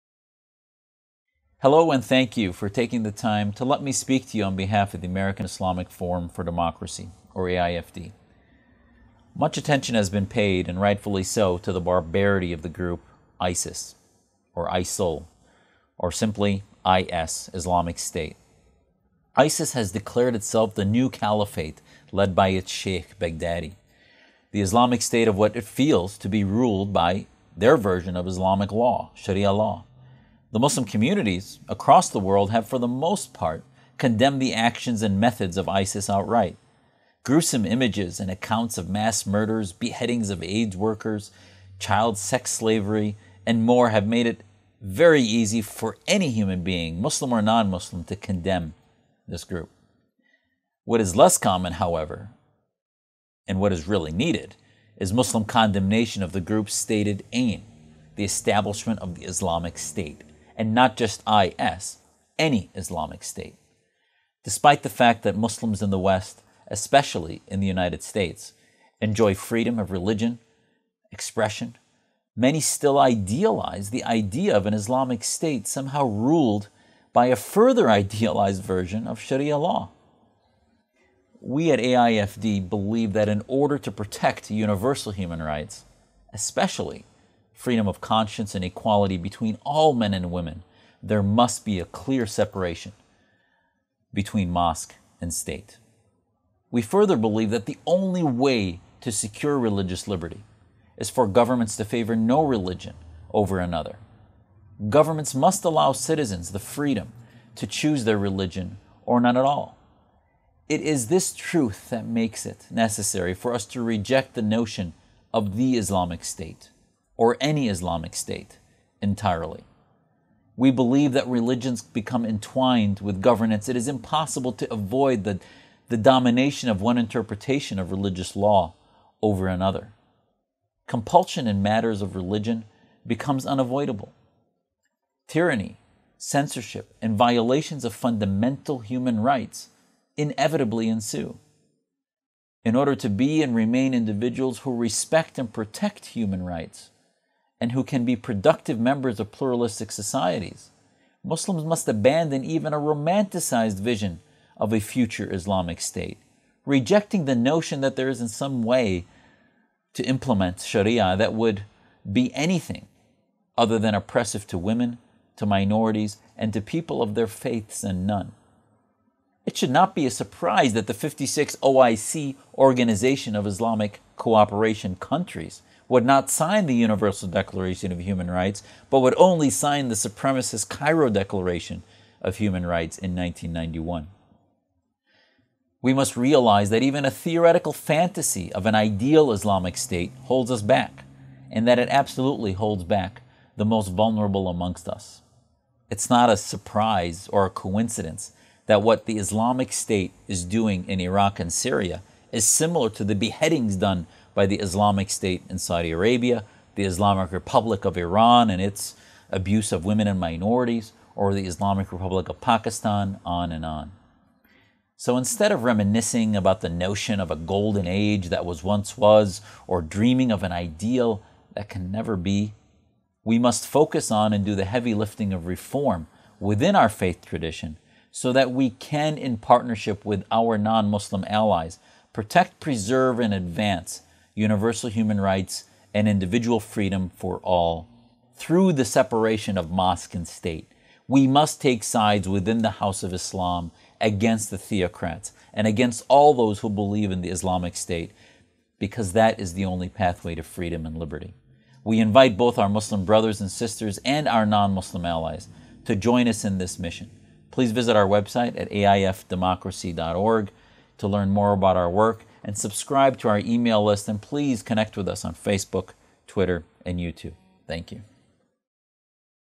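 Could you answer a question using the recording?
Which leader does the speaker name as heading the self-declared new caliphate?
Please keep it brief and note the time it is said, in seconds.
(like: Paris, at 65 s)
Sheikh Baghdadi, at 22 s.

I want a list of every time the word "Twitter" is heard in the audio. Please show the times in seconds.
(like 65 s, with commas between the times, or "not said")
266 s.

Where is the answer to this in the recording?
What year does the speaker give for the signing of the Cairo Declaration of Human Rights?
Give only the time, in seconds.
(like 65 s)
183 s.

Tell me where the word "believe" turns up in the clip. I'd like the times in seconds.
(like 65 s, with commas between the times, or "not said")
82 s, 97 s, 120 s, 246 s.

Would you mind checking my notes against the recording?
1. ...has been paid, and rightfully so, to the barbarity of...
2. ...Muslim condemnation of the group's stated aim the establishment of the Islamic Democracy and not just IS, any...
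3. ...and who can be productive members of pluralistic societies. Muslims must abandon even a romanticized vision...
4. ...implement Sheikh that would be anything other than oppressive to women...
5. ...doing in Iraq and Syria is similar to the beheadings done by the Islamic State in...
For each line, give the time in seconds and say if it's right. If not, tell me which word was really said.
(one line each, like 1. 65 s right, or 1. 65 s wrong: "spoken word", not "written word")
1. 9 s right
2. 55 s wrong: "State", not "Democracy"
3. 147 s right
4. 160 s wrong: "Sharia", not "Sheikh"
5. 200 s right.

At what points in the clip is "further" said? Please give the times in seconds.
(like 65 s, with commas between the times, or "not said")
77 s, 96 s.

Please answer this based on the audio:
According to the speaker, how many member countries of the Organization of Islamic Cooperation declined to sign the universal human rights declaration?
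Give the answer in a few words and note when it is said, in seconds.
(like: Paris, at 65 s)
56, at 170 s.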